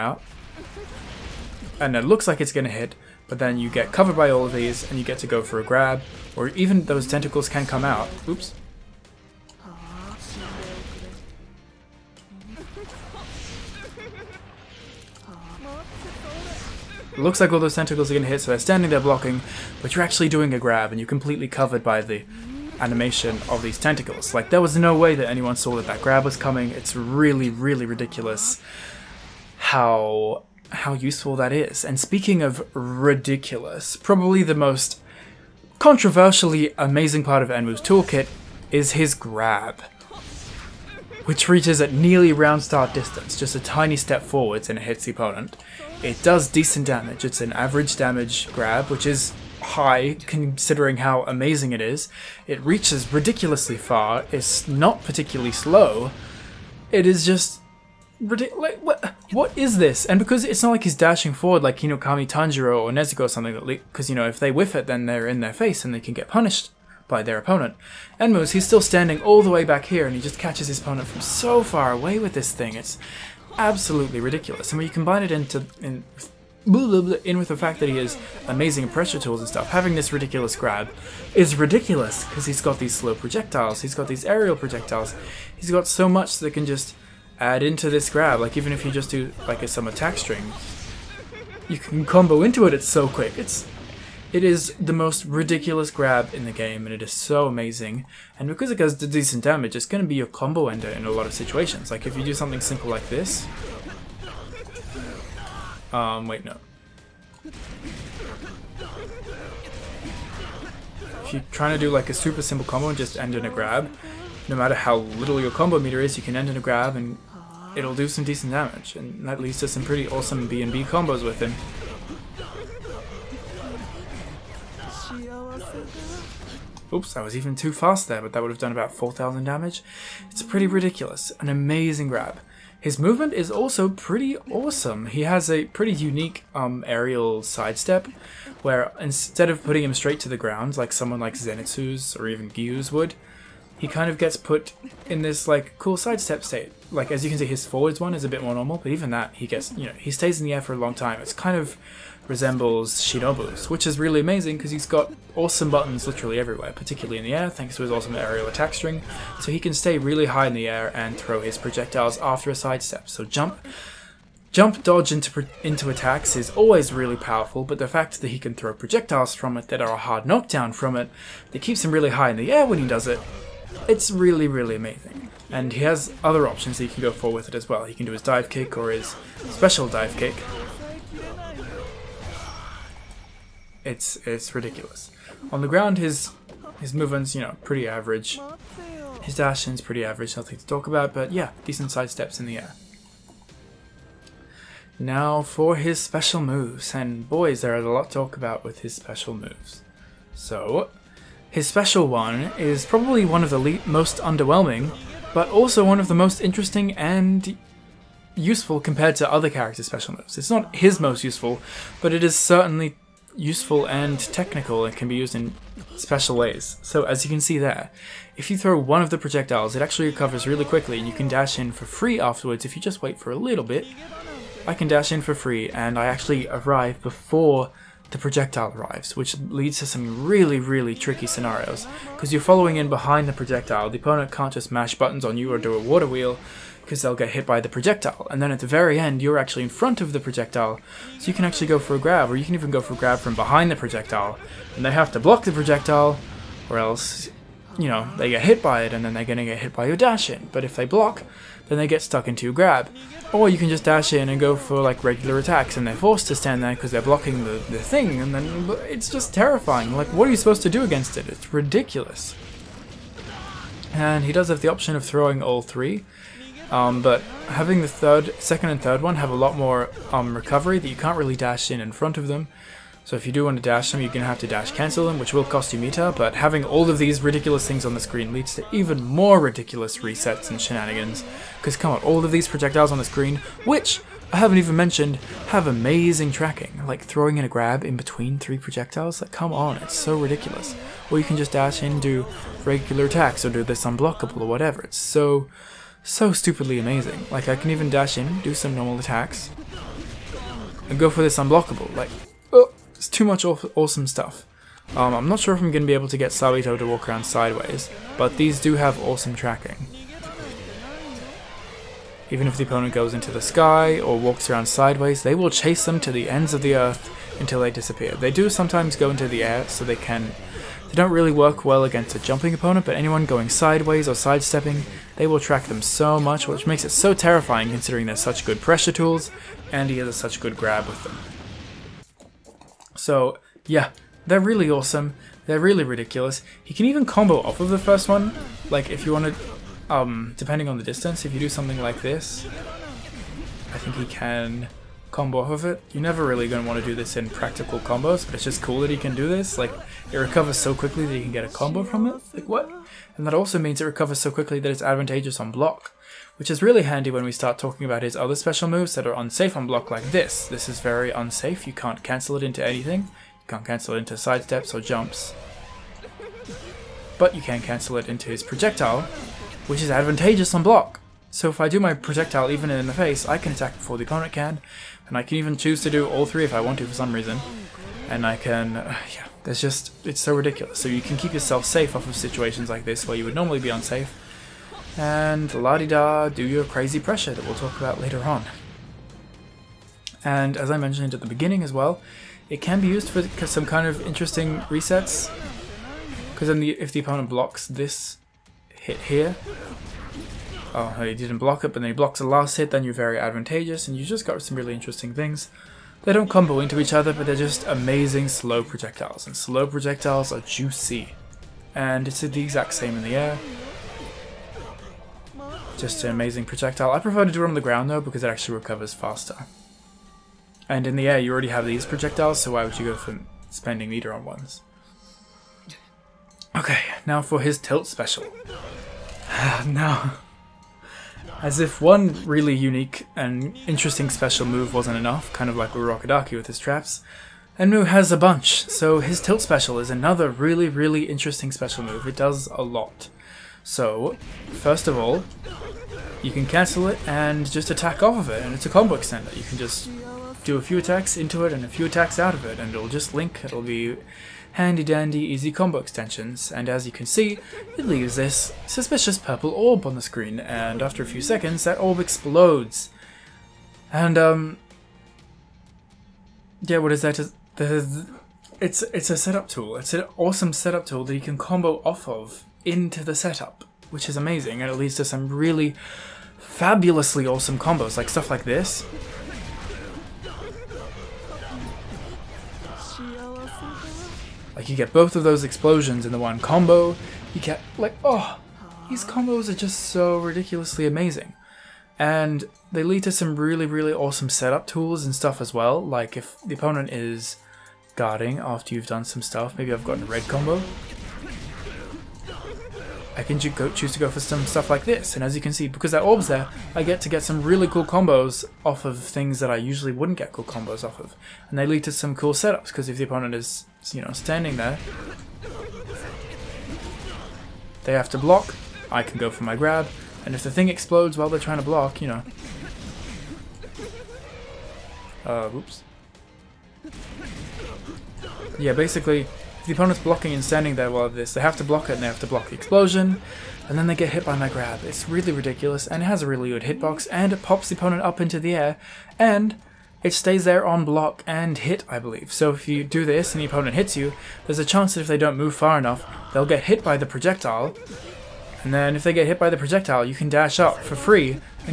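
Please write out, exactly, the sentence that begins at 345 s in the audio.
You're never really going to want to do this in practical combos, but it's just cool that he can do this.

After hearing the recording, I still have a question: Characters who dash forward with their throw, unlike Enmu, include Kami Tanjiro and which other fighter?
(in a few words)
Nezuko.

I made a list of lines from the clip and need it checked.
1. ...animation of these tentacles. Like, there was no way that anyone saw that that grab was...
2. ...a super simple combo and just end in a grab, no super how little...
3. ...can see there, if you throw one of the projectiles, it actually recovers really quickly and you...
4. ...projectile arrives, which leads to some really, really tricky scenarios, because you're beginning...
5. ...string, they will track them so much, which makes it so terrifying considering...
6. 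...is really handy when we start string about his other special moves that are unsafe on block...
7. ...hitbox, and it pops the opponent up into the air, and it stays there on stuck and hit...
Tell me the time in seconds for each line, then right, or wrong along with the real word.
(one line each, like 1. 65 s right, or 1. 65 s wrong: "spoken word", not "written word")
1. 22 s right
2. 112 s wrong: "matter", not "super"
3. 217 s right
4. 228 s wrong: "following", not "beginning"
5. 324 s wrong: "sidestepping", not "string"
6. 356 s wrong: "talking", not "string"
7. 536 s wrong: "block", not "stuck".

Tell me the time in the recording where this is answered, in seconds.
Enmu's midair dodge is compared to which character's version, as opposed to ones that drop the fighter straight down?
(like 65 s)
153 s.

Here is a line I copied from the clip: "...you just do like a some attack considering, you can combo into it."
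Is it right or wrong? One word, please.
wrong.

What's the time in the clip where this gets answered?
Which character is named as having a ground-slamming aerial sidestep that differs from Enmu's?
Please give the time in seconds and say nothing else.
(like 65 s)
141 s.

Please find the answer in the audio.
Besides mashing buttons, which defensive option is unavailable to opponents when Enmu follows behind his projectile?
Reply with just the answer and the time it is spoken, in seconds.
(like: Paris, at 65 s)
Water wheel, at 235 s.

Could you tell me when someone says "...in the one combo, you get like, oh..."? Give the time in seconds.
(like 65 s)
486 s.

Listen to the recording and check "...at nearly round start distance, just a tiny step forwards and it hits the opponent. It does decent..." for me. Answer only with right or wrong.
right.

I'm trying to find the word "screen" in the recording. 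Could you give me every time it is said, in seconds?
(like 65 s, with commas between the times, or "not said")
277 s, 283 s, 460 s.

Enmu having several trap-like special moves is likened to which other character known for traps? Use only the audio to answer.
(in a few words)
Urokodaki.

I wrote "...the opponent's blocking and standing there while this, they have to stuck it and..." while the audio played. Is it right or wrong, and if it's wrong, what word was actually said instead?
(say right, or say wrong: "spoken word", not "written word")
wrong: "block", not "stuck".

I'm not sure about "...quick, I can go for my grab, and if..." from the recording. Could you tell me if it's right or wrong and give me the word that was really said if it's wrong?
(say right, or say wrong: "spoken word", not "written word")
wrong: "block", not "quick".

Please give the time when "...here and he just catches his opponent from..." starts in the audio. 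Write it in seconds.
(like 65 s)
69 s.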